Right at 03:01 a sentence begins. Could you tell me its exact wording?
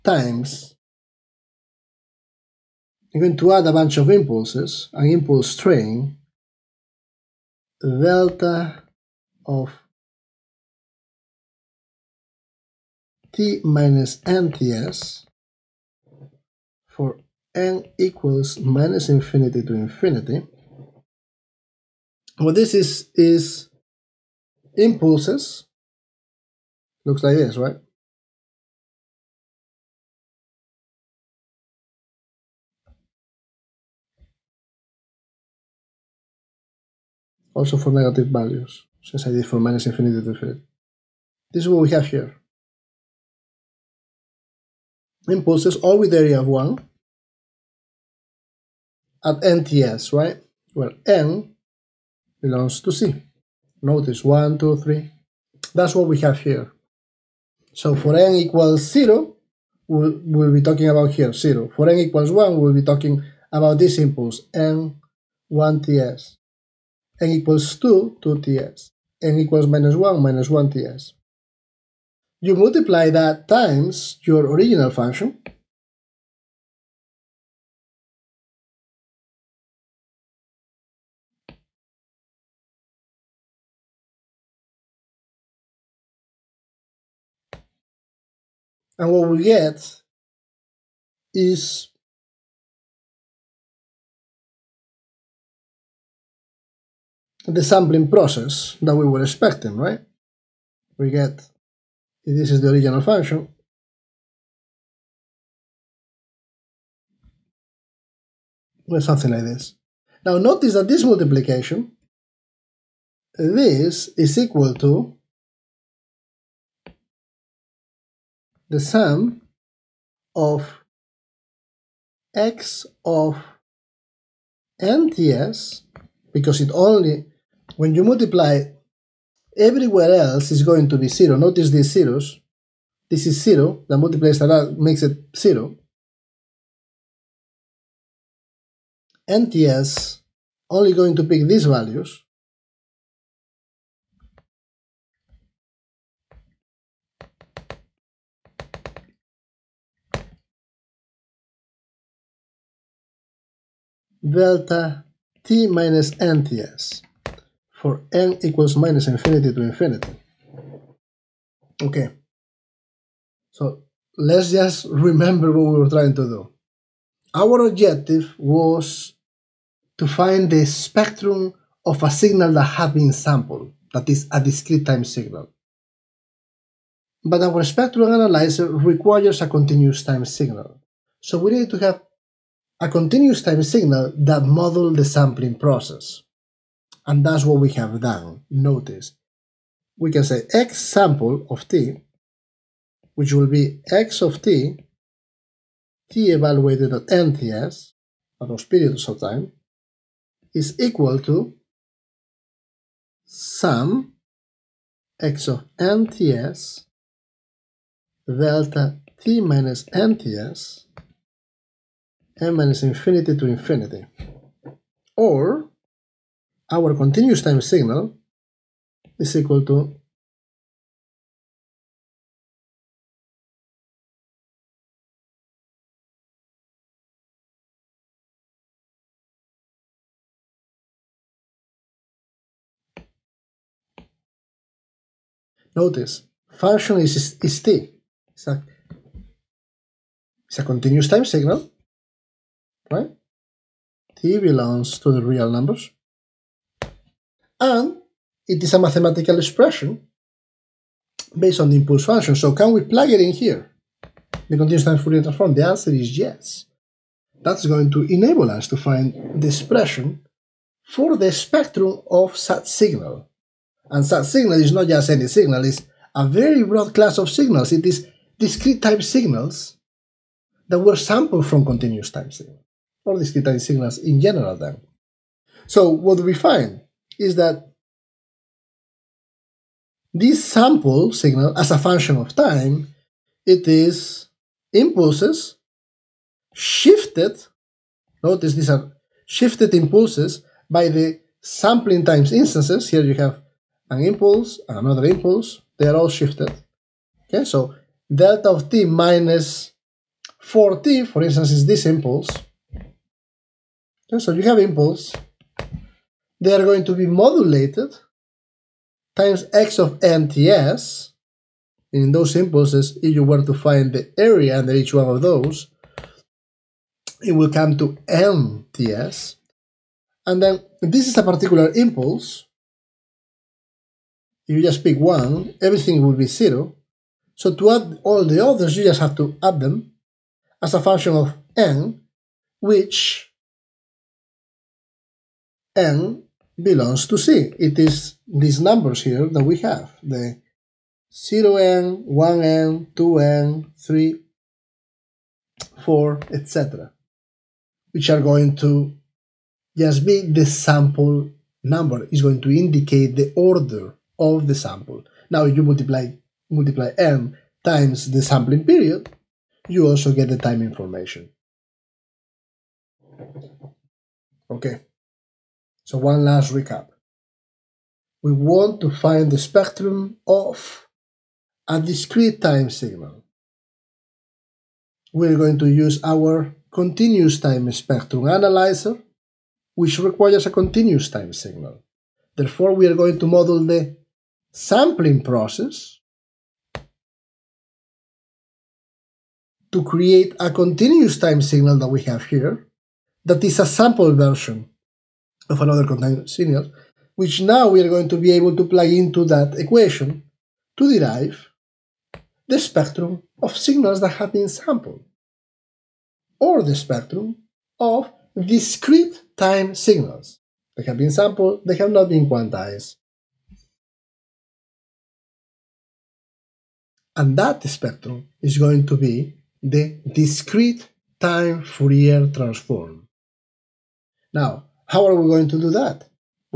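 So we need to have a continuous time signal that model the sampling process.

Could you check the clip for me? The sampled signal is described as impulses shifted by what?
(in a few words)
sampling times instances.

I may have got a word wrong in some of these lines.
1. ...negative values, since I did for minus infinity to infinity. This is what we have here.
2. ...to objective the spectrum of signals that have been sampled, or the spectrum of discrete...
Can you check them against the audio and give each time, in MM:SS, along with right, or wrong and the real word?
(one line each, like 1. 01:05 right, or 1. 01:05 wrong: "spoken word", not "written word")
1. 00:37 right
2. 06:40 wrong: "derive", not "objective".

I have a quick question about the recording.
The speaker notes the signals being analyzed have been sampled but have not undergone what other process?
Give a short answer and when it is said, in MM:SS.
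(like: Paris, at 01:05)
quantized, at 06:52.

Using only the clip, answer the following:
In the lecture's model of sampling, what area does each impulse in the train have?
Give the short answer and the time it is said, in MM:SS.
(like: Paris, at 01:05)
1, at 00:46.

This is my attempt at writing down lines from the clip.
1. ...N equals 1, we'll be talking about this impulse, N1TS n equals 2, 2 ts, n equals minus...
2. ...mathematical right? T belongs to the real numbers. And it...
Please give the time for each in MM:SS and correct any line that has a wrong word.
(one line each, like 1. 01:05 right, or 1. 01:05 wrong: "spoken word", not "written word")
1. 01:01 right
2. 04:01 wrong: "signal", not "mathematical".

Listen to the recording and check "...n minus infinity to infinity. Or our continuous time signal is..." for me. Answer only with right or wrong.
right.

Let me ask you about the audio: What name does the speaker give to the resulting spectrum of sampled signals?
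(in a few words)
discrete time Fourier transform.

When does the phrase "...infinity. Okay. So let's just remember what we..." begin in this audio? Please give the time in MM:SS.
02:39.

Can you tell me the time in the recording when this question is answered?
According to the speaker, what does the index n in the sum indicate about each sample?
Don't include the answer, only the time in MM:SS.
05:53.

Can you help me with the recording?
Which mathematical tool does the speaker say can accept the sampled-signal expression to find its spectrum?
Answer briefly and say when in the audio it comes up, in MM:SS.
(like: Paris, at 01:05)
continuous time Fourier transform, at 04:14.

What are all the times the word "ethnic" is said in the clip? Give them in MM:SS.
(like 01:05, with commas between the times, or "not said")
not said.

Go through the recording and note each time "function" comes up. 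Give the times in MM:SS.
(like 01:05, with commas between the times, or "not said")
01:14, 01:43, 03:56, 04:12, 04:41, 05:30.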